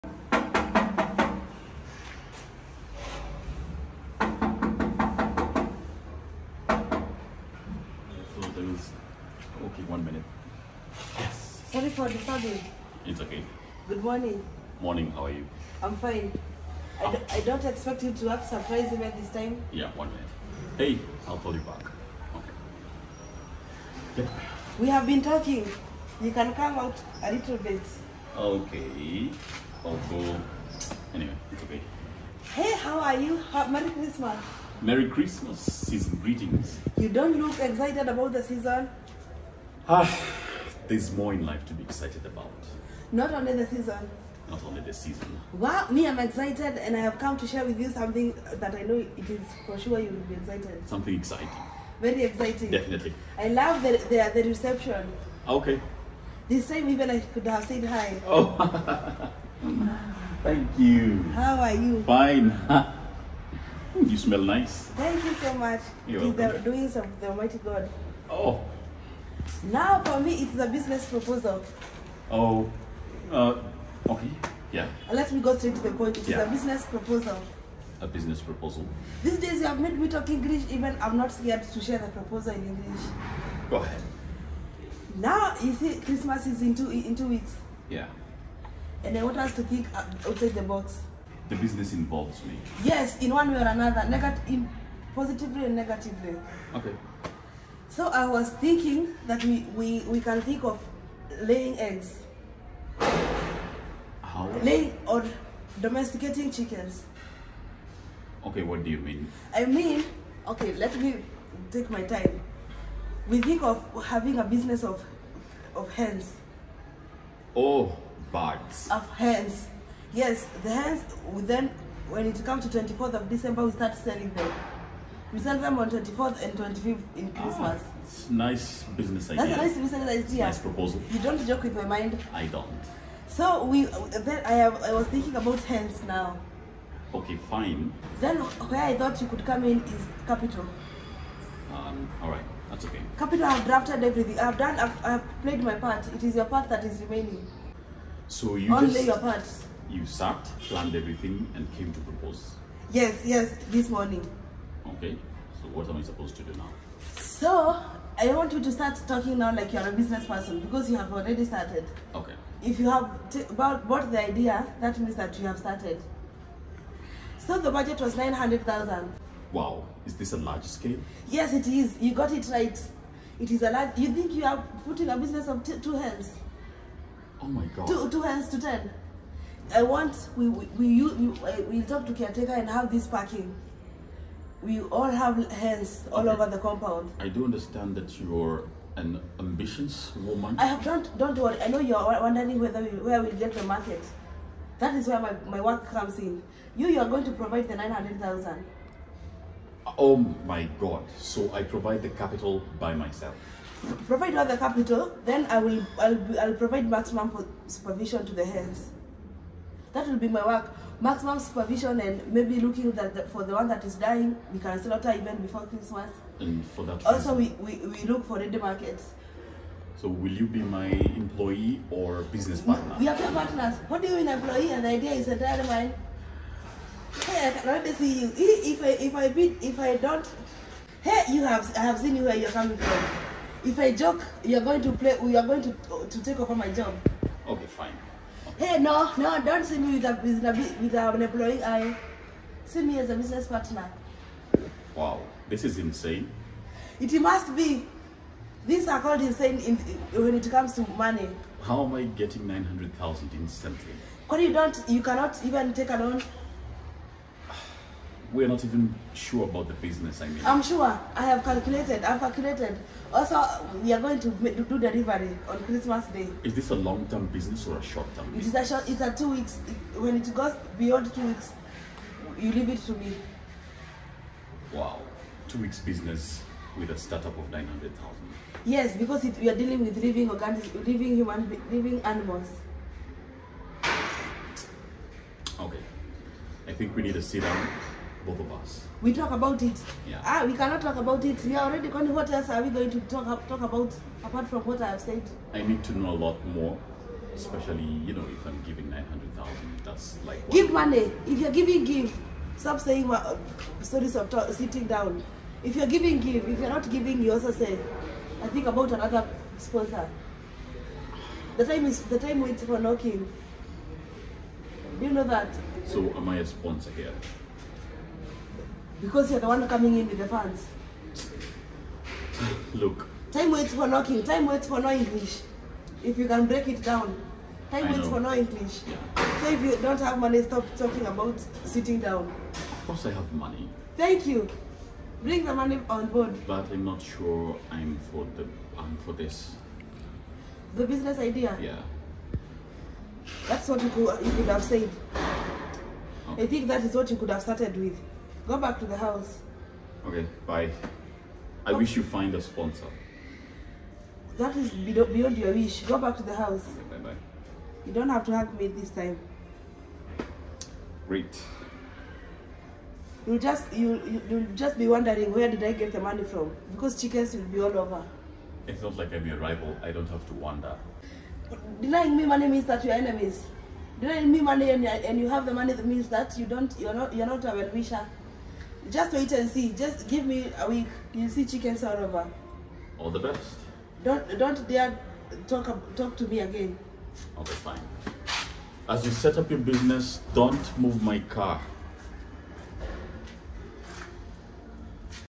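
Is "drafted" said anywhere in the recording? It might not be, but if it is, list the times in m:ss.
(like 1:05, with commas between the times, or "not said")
2:23.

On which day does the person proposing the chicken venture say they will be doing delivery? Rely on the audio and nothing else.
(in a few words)
Christmas Day.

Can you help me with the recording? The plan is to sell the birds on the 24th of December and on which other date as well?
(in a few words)
25th.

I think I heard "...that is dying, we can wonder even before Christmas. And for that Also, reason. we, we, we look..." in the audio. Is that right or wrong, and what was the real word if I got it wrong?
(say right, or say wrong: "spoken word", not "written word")
wrong: "slaughter", not "wonder".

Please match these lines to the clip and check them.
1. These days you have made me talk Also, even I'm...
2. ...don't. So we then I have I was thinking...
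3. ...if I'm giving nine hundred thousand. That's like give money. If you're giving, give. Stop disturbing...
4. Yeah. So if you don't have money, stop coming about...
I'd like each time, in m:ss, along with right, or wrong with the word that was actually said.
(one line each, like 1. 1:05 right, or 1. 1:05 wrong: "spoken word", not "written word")
1. 1:19 wrong: "English", not "Also"
2. 2:12 right
3. 4:58 wrong: "saying", not "disturbing"
4. 5:28 wrong: "talking", not "coming".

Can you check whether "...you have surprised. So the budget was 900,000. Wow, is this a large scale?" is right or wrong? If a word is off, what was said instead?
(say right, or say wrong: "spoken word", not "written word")
wrong: "started", not "surprised".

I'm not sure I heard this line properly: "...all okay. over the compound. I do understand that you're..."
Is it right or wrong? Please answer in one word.
right.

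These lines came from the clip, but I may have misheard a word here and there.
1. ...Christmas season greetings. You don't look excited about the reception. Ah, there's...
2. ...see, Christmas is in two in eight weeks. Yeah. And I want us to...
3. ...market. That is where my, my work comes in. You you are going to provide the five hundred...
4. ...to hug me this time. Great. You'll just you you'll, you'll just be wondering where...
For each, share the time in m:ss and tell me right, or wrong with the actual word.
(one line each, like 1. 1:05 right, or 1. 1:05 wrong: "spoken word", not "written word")
1. 0:35 wrong: "season", not "reception"
2. 1:25 wrong: "two", not "eight"
3. 3:13 wrong: "nine", not "five"
4. 5:58 right.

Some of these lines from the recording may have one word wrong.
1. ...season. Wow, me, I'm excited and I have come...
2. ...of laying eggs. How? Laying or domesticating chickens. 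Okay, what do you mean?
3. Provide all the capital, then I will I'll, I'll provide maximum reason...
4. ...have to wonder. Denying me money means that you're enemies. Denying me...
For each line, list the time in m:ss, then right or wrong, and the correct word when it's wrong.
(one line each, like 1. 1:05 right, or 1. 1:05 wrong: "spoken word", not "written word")
1. 0:44 right
2. 1:40 right
3. 3:24 wrong: "supervision", not "reason"
4. 6:10 right.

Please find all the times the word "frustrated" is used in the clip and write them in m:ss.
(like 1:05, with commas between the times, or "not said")
not said.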